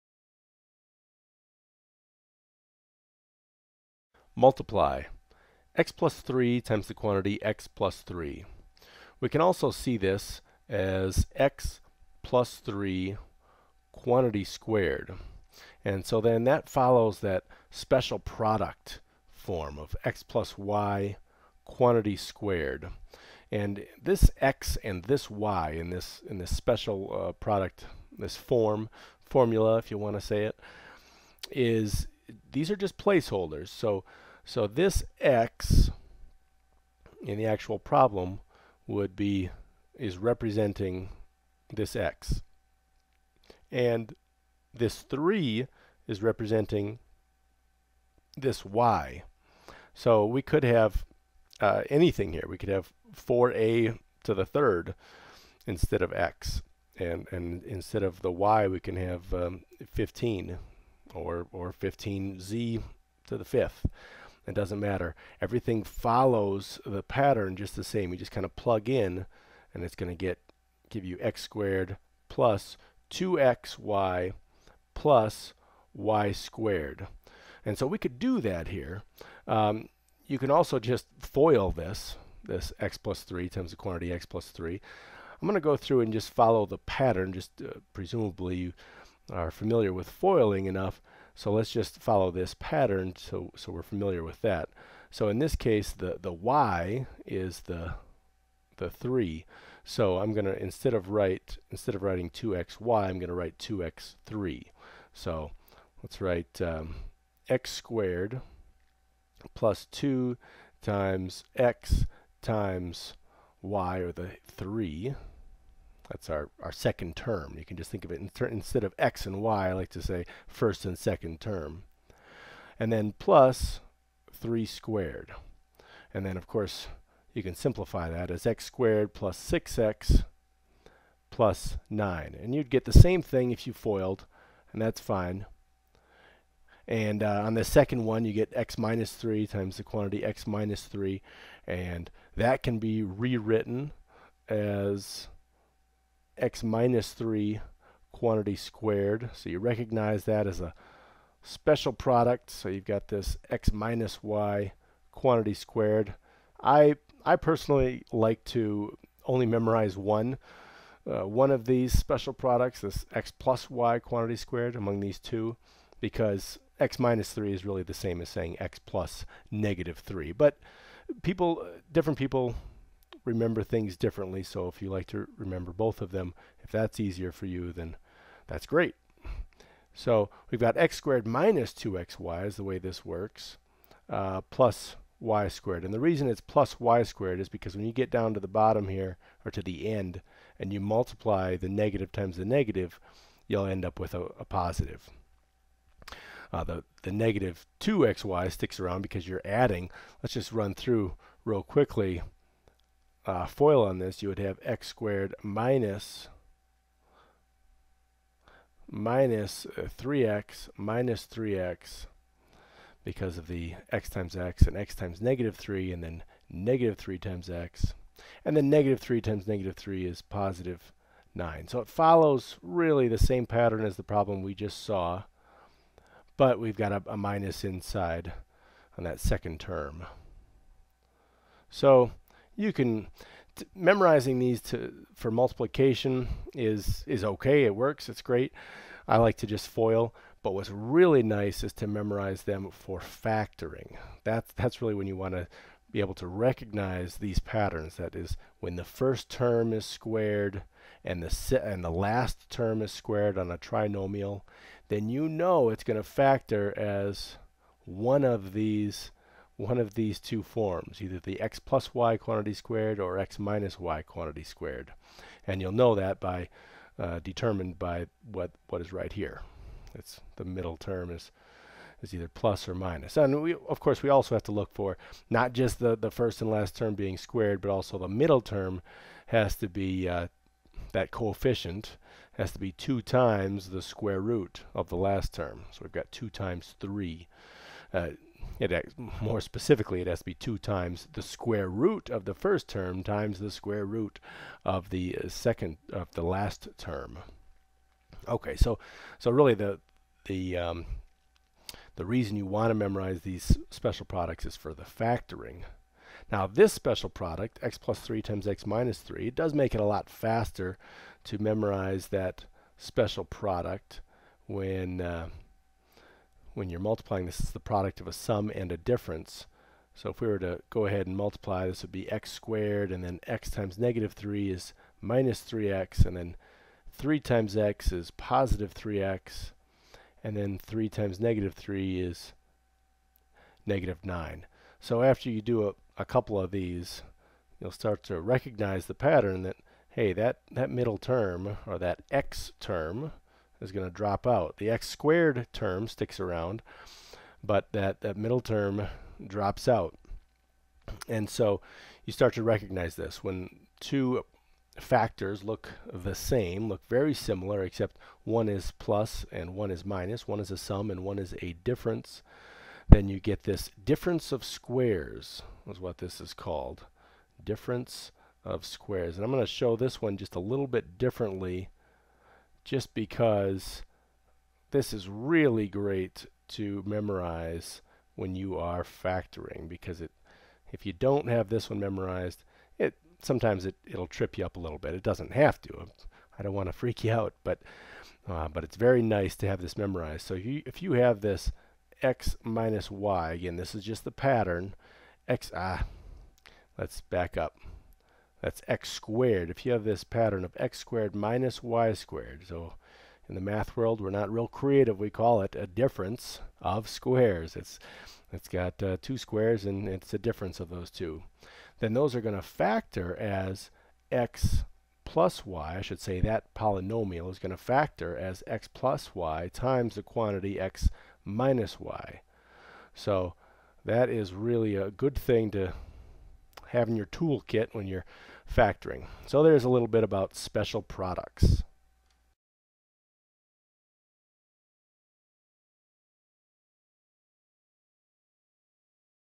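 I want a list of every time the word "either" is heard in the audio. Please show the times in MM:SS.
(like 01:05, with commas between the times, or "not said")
04:21, 04:32.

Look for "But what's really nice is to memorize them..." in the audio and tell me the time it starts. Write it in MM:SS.
04:00.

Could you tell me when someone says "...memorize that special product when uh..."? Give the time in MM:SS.
05:11.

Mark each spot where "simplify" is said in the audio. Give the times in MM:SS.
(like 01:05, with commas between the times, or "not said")
02:07.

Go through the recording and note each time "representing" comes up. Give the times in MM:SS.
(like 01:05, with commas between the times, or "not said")
00:40, 00:46.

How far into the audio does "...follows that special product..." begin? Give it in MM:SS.
00:16.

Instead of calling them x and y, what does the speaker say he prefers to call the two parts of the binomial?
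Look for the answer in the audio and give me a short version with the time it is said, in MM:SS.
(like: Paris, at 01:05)
first and second term, at 02:00.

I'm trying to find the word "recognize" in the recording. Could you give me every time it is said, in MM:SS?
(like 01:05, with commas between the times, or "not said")
02:29, 04:06, 05:38, 05:52.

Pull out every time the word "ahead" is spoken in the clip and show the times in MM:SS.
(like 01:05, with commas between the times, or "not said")
05:20.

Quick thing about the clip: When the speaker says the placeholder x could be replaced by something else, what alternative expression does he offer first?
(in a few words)
4a to the third.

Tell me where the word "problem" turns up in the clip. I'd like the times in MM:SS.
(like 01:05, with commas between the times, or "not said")
00:37, 03:44.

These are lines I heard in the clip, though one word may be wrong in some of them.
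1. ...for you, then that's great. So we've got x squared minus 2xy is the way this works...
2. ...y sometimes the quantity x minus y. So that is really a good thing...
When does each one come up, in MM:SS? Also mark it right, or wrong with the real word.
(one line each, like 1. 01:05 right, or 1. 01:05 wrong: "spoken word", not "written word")
1. 02:57 right
2. 06:59 wrong: "times", not "sometimes".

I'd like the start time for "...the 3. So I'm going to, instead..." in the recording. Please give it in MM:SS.
01:38.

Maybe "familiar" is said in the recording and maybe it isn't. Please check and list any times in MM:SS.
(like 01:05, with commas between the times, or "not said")
01:29, 01:33.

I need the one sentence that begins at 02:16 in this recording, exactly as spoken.
And uh, on the second one, you get x minus 3 times the quantity x minus 3.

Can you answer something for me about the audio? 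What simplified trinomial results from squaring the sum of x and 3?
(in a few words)
x squared plus 6x plus 9.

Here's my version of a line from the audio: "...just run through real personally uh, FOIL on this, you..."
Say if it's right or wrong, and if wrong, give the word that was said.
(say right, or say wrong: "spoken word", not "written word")
wrong: "quickly", not "personally".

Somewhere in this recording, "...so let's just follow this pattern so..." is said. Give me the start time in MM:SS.
01:31.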